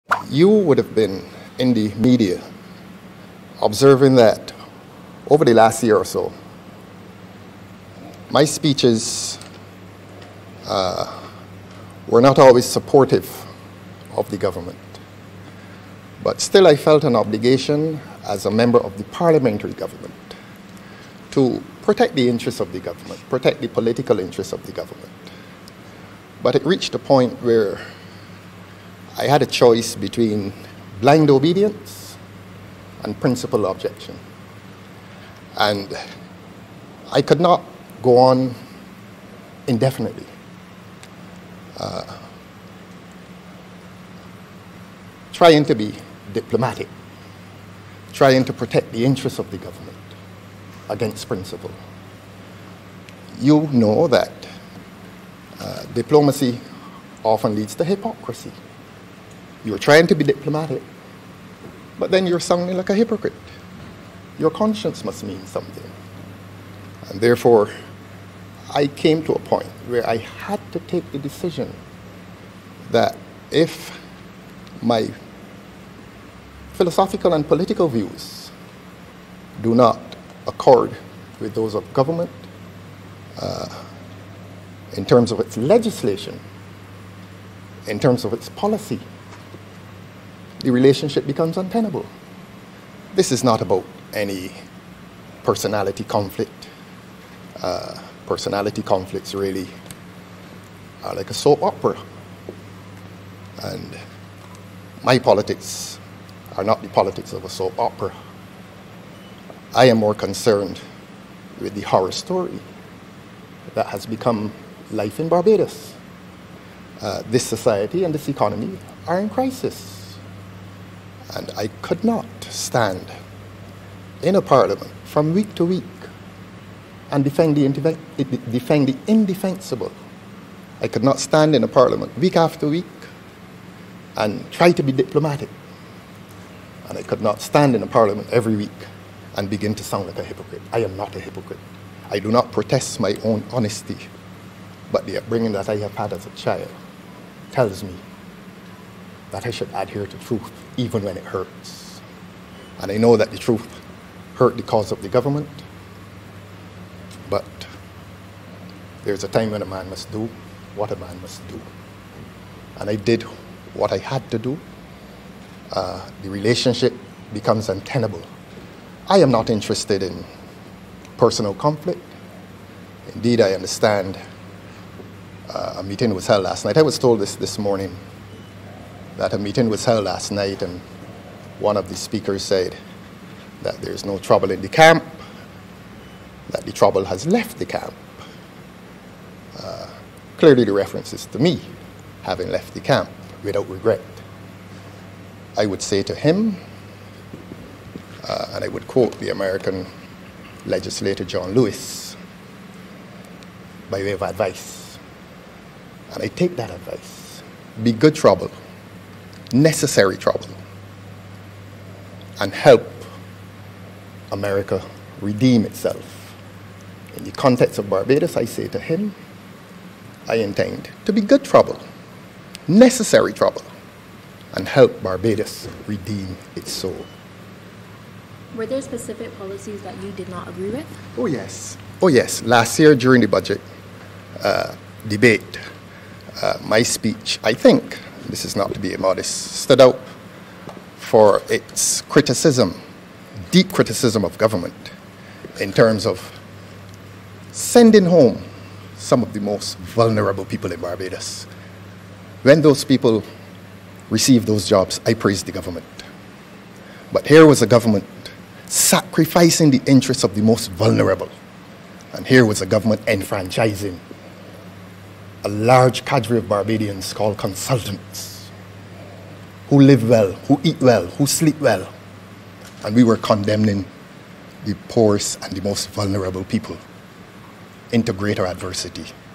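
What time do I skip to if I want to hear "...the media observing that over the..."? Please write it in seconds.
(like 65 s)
1 s.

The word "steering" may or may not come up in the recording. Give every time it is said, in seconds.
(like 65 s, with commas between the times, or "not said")
not said.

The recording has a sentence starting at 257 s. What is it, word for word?
But here was a government sacrificing the interests of the most vulnerable.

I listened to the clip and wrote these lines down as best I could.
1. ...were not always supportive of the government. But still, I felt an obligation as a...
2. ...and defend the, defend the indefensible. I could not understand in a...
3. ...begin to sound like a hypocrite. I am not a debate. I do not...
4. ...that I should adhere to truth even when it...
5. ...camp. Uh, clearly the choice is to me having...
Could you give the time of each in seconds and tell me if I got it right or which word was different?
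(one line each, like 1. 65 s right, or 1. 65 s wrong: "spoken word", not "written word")
1. 12 s right
2. 127 s wrong: "stand", not "understand"
3. 139 s wrong: "hypocrite", not "debate"
4. 149 s right
5. 187 s wrong: "reference", not "choice".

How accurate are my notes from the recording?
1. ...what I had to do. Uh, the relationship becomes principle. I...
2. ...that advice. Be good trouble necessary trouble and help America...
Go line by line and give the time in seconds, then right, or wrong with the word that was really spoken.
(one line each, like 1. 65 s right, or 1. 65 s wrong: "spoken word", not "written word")
1. 163 s wrong: "untenable", not "principle"
2. 206 s right.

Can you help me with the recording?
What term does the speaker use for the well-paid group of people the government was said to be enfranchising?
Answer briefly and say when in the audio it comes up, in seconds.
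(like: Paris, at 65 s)
consultants, at 267 s.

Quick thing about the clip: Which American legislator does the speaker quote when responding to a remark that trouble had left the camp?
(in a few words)
John Lewis.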